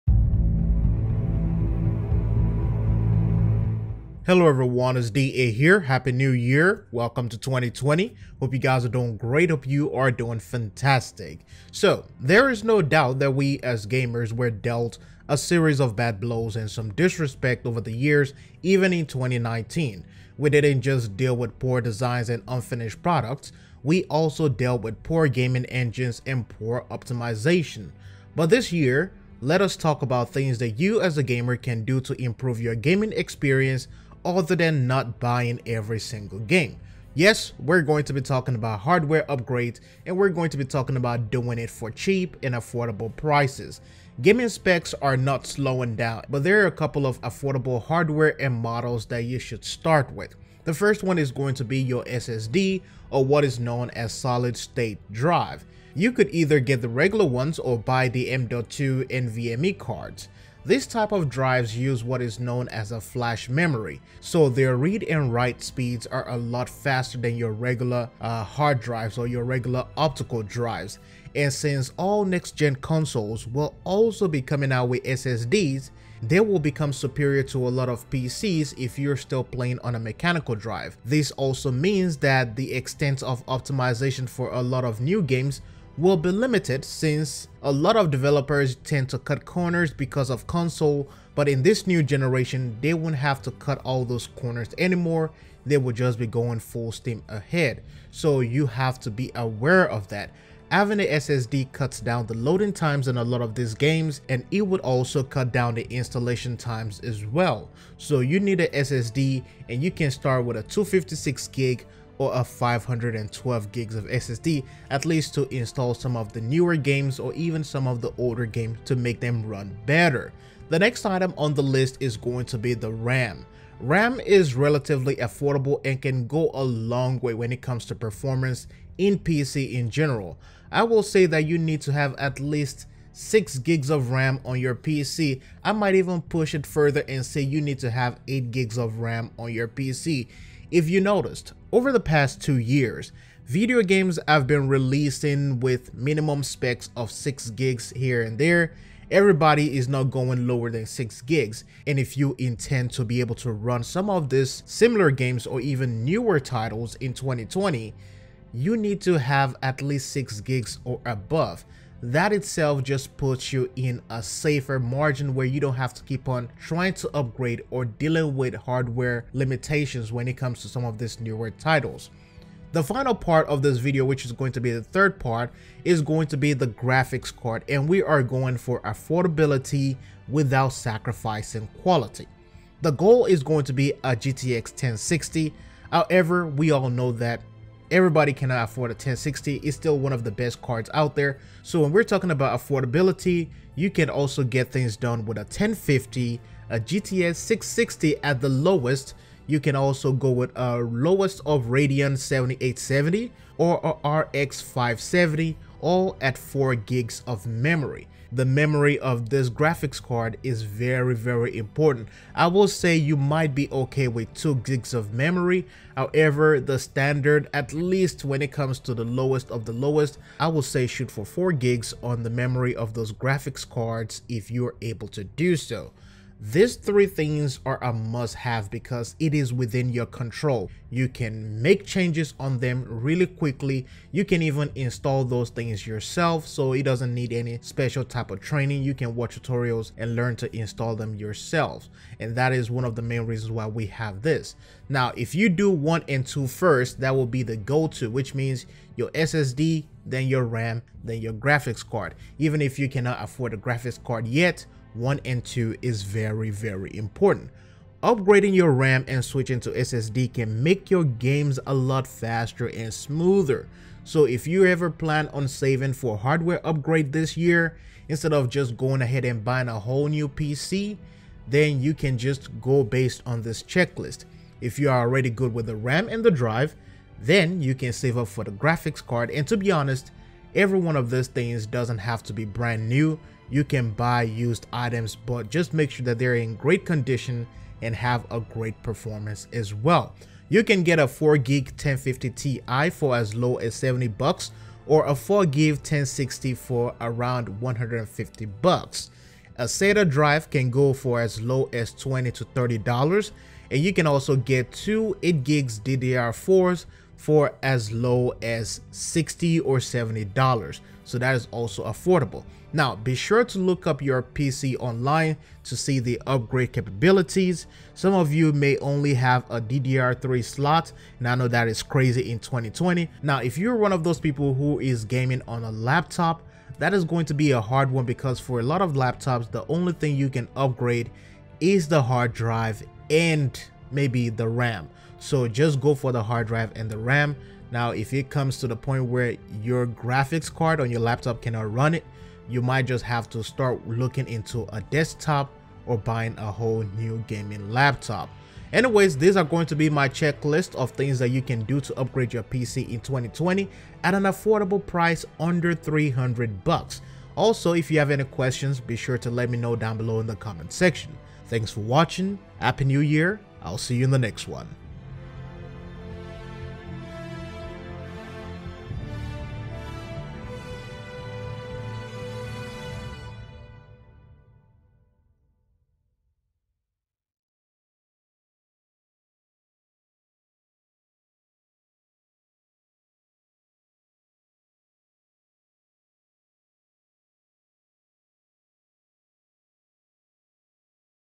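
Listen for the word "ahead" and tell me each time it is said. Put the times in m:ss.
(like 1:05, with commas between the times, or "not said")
1:37, 4:29.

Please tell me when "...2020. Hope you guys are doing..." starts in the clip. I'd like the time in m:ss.
0:07.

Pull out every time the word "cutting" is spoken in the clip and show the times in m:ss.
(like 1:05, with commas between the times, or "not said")
not said.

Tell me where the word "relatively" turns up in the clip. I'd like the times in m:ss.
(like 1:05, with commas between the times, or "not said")
2:04.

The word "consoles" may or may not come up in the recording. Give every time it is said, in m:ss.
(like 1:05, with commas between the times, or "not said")
1:12, 1:30.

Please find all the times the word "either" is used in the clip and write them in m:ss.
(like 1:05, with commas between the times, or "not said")
0:56.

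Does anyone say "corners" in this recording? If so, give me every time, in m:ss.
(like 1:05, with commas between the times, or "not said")
1:29, 1:34.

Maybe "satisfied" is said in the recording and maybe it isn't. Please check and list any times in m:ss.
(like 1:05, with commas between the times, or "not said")
not said.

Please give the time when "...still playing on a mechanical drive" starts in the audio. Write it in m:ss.
1:19.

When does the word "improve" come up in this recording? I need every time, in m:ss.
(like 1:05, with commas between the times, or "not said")
0:32.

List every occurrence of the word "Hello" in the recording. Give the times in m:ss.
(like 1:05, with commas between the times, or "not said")
0:04.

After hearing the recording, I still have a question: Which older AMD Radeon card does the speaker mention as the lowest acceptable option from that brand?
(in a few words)
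Radeon 7870.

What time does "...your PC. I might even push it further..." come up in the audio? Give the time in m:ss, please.
2:14.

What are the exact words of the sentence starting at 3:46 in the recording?
These three things are a must have because it is within your control.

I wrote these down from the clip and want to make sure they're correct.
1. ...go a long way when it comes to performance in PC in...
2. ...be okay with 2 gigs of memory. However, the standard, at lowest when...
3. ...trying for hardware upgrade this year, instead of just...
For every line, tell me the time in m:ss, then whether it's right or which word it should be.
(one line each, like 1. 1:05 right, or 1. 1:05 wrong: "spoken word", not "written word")
1. 2:06 right
2. 3:33 wrong: "least", not "lowest"
3. 4:25 wrong: "saving", not "trying".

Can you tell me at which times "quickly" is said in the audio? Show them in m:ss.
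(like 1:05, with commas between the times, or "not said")
3:53.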